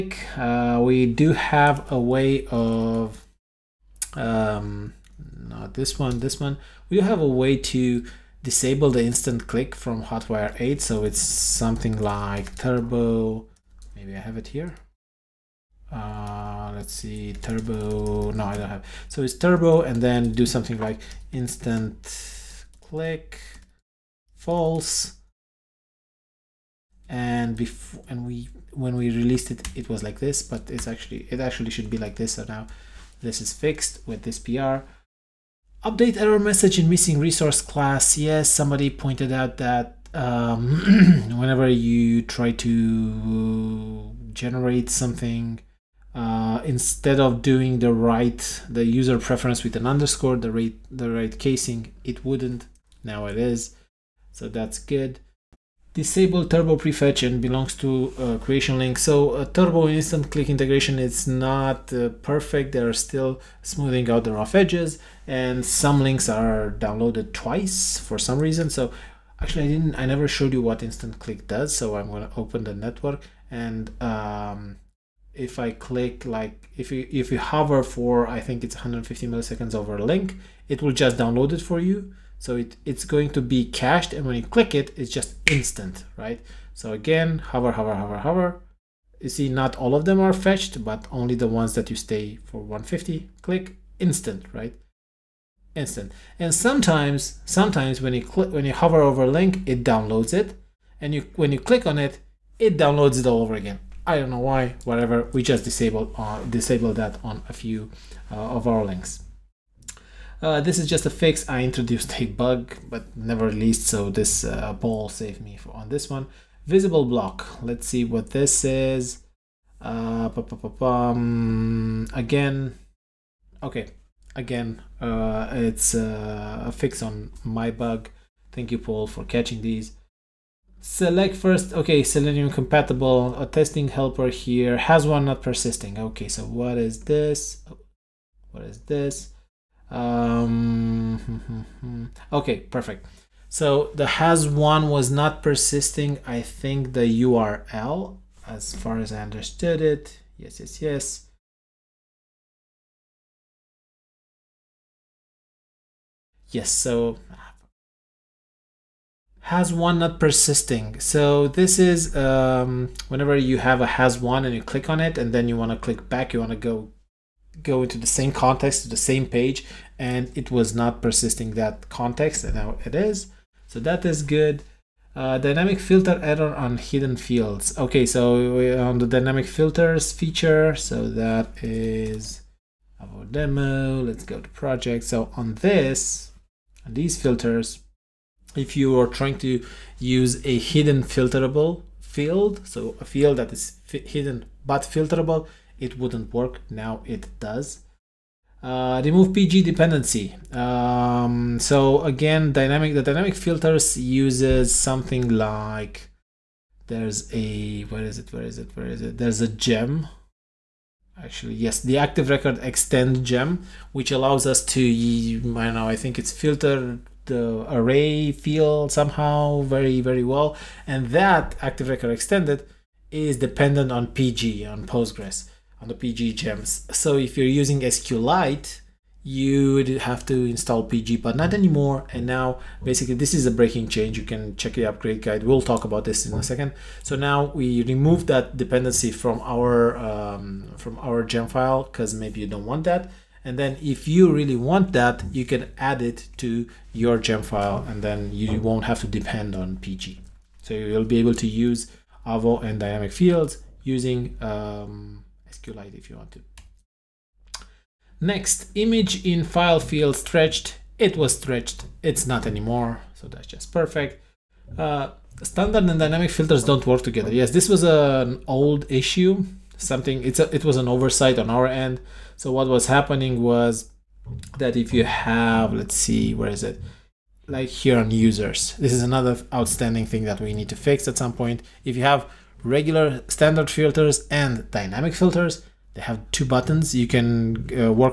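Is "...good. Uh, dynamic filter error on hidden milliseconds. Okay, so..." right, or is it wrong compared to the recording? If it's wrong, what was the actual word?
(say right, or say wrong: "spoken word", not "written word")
wrong: "fields", not "milliseconds".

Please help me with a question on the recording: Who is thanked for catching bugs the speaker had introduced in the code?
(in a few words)
Paul.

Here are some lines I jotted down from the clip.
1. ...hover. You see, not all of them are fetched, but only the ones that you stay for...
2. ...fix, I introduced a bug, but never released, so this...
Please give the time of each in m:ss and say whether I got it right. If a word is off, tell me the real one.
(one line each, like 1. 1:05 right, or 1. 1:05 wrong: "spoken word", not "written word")
1. 1:28 right
2. 1:51 right.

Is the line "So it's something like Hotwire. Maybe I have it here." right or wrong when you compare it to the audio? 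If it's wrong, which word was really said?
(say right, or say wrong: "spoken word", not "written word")
wrong: "Turbo", not "Hotwire".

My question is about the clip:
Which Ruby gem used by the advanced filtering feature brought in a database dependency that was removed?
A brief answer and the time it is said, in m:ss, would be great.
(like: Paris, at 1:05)
Active Record Extended, at 3:31.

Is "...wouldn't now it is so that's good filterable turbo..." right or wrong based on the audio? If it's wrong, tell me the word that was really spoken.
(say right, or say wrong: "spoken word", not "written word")
wrong: "disable", not "filterable".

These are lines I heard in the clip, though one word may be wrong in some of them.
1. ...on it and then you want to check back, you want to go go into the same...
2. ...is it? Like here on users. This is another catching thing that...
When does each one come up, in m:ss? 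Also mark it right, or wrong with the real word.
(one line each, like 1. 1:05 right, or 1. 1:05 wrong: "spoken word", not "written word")
1. 2:44 wrong: "click", not "check"
2. 4:36 wrong: "outstanding", not "catching".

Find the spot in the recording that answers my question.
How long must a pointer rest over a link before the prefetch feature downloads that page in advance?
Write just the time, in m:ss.
1:18.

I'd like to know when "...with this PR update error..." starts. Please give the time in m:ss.
0:34.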